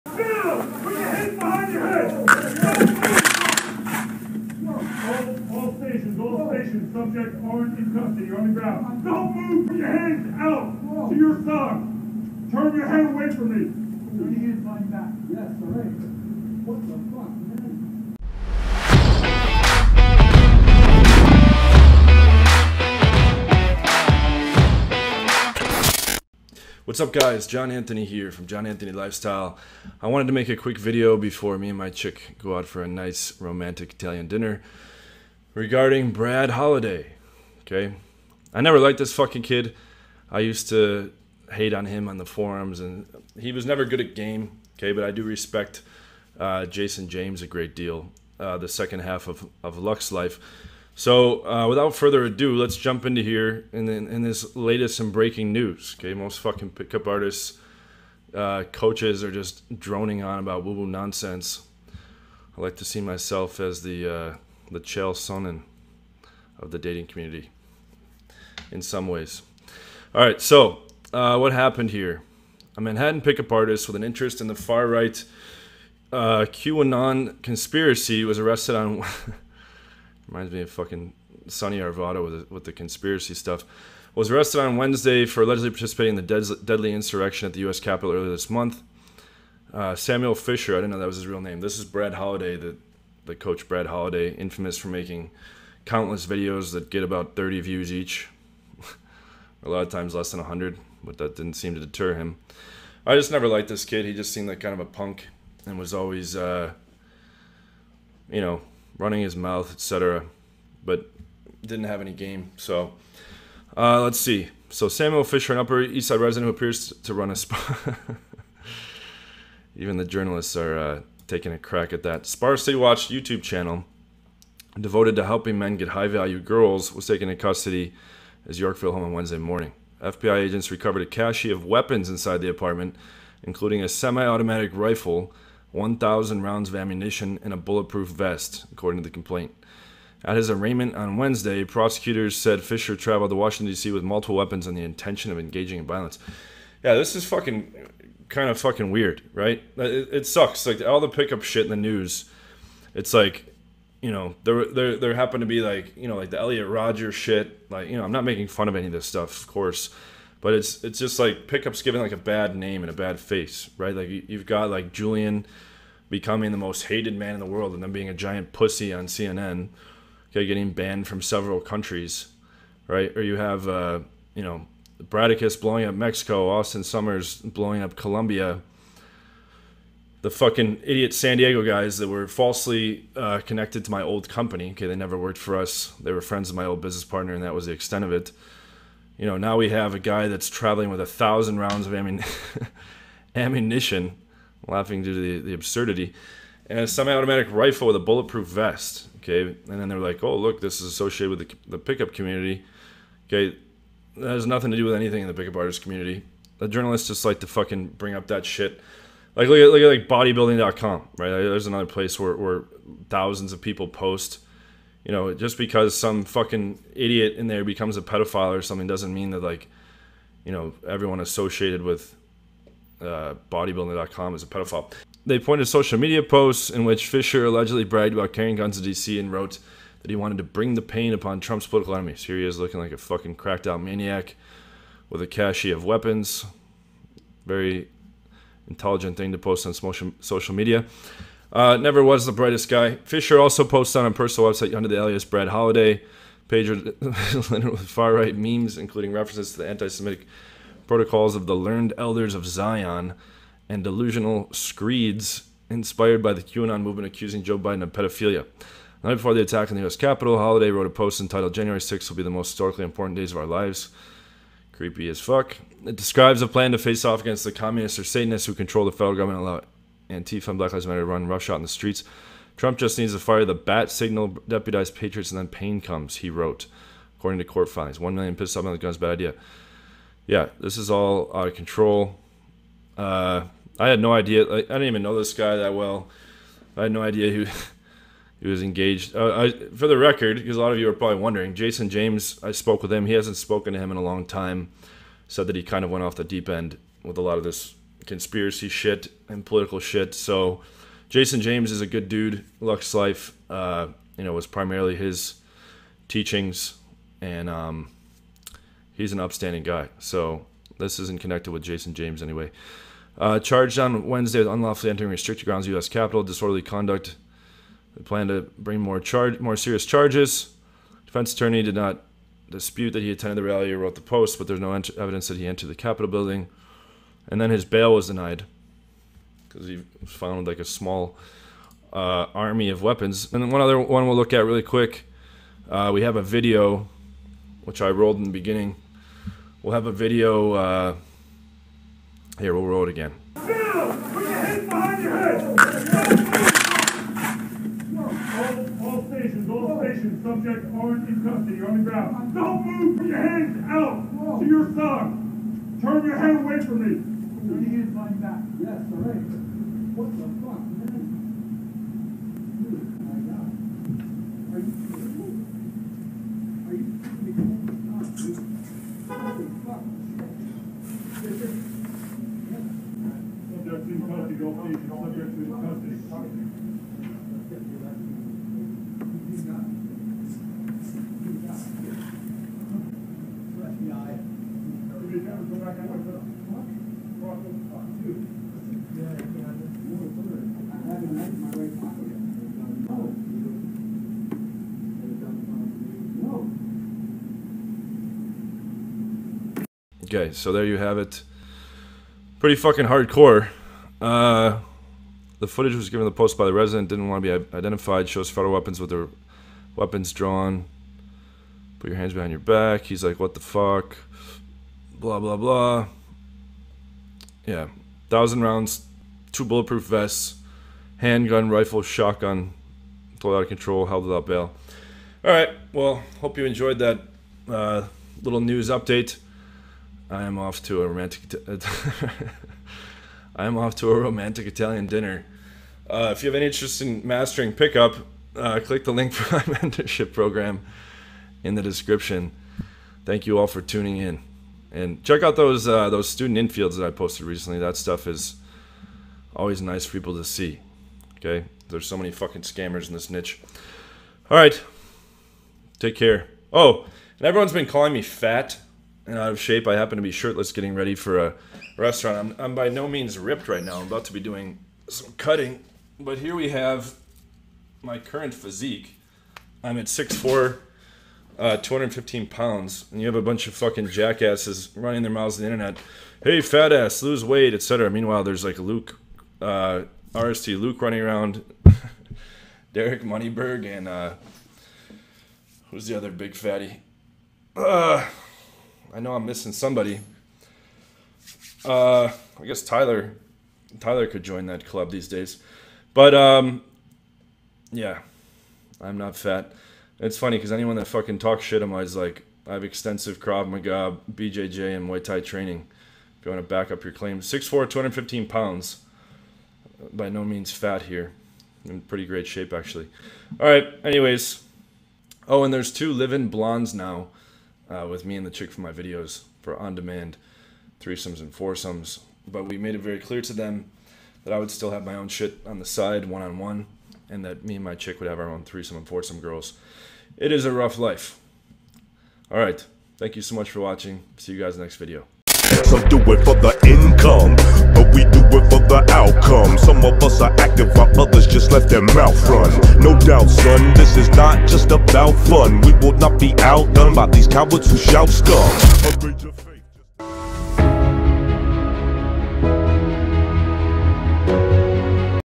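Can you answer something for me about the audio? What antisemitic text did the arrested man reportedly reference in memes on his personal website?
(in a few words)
Protocols of the Learned Elders of Zion.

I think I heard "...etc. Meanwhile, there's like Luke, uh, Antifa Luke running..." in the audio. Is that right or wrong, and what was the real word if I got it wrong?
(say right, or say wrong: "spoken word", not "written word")
wrong: "RSD", not "Antifa".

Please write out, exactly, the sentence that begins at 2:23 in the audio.
with multiple weapons and the intention of engaging in violence.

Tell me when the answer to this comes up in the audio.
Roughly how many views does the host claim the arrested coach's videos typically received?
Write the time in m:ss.
1:37.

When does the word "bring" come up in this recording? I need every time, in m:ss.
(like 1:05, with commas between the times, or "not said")
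3:27, 3:50, 5:18.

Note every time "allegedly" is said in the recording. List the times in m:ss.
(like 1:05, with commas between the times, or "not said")
1:25, 3:47.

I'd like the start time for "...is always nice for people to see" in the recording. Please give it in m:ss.
7:28.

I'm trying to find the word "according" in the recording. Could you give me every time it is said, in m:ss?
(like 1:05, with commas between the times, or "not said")
2:18, 4:37.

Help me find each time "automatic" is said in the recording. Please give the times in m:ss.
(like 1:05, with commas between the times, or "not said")
2:14, 3:16.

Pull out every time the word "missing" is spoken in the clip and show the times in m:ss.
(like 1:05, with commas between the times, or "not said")
8:09.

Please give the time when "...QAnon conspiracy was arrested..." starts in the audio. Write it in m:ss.
1:16.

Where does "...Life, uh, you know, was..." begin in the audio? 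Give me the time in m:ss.
5:02.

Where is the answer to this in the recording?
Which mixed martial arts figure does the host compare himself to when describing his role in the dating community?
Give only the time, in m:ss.
1:04.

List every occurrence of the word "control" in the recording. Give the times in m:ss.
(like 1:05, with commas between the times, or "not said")
4:28, 4:41, 7:03.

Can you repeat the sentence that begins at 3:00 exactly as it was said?
The fucking idiot San Diego guys that were falsely uh, connected to my old company.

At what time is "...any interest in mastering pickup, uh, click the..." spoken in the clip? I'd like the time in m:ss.
7:16.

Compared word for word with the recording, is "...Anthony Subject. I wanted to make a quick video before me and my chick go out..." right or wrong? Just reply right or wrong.
wrong.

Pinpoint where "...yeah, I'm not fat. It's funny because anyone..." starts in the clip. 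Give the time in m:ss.
8:17.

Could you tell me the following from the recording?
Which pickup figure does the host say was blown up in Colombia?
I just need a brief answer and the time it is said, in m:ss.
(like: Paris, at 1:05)
Austin Summers, at 2:56.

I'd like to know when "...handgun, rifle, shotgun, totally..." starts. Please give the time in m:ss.
7:00.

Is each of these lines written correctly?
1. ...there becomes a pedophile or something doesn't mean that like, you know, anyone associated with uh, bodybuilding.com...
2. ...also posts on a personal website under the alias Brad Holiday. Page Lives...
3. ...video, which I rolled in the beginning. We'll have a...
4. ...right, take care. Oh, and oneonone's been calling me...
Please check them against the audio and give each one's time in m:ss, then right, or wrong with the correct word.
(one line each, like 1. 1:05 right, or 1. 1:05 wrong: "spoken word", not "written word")
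1. 3:37 wrong: "everyone", not "anyone"
2. 4:03 wrong: "Leonard", not "Lives"
3. 5:36 right
4. 7:34 wrong: "everyone", not "oneonone".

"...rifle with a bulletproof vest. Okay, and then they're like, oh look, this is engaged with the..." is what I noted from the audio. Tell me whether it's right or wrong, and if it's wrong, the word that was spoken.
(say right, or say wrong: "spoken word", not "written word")
wrong: "associated", not "engaged".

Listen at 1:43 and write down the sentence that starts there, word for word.
I just never liked this kid.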